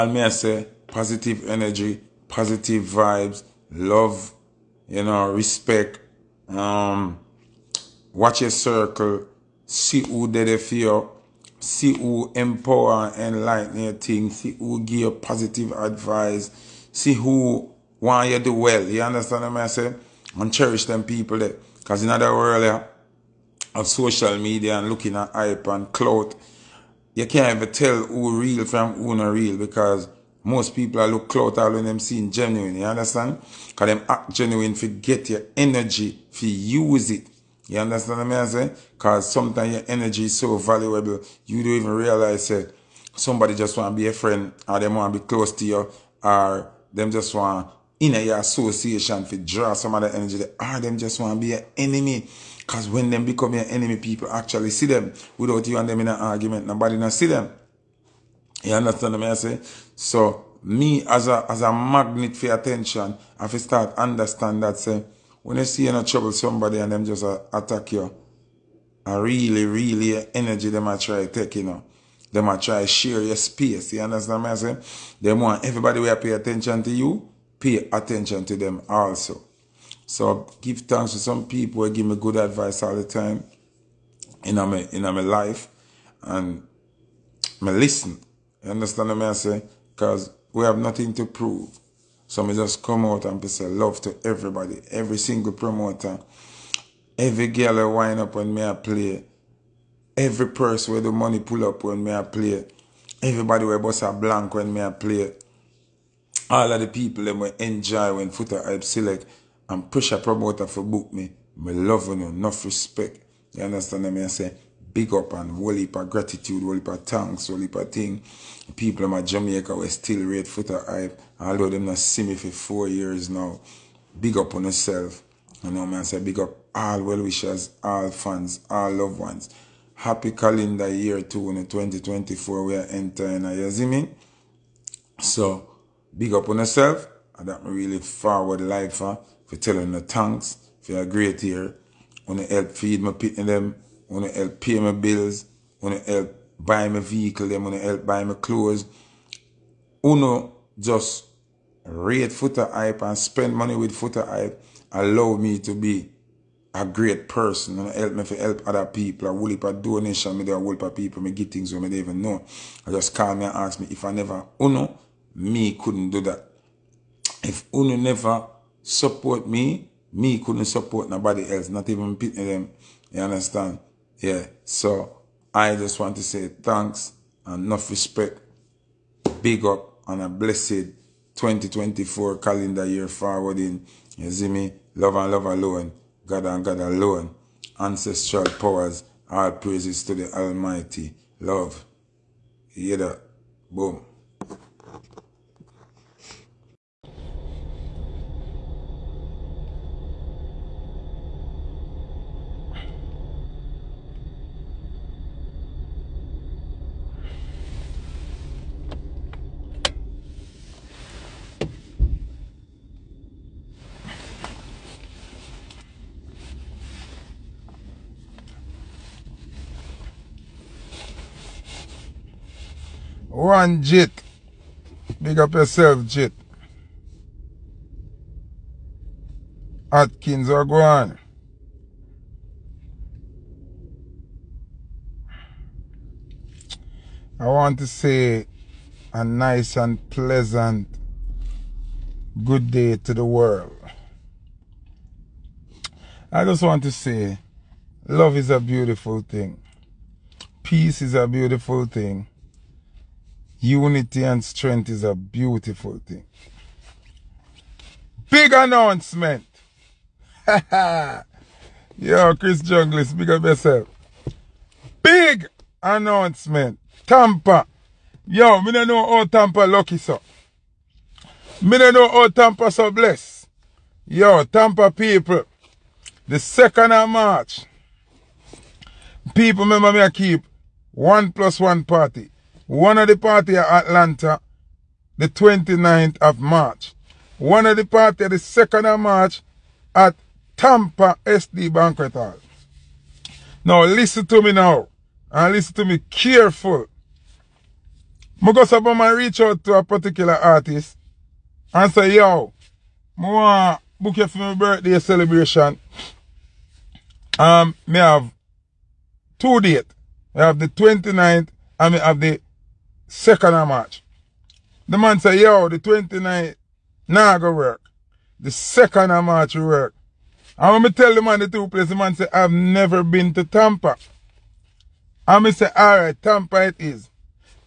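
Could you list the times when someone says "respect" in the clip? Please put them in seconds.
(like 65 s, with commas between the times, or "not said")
5 s, 112 s, 177 s.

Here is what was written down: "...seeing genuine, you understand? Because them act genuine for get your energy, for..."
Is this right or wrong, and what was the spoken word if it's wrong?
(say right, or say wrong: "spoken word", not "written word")
right.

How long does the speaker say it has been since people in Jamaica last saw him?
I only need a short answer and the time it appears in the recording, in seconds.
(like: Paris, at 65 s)
4 years, at 122 s.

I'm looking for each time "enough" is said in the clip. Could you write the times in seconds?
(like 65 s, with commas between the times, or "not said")
112 s, 177 s.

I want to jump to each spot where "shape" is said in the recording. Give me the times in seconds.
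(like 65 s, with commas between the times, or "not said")
not said.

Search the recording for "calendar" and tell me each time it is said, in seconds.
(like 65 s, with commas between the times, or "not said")
130 s, 182 s.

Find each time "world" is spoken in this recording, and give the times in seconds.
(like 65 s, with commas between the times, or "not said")
22 s, 243 s.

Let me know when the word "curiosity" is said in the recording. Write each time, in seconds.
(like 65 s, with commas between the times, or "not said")
not said.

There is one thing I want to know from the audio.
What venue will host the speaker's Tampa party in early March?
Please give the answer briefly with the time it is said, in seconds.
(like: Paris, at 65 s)
SD Banquet Hall, at 291 s.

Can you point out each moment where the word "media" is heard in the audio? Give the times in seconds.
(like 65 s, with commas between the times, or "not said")
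24 s.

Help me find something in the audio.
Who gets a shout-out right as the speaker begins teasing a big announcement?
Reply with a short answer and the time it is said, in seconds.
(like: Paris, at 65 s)
Chris Jungles, at 262 s.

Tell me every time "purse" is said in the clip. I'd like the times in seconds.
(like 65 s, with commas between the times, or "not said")
100 s.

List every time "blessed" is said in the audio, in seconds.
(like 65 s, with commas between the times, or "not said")
180 s, 272 s.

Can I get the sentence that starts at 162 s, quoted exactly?
I just call me and ask me if I never, uno, me couldn't do that.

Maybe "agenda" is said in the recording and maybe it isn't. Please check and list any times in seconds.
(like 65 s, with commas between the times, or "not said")
not said.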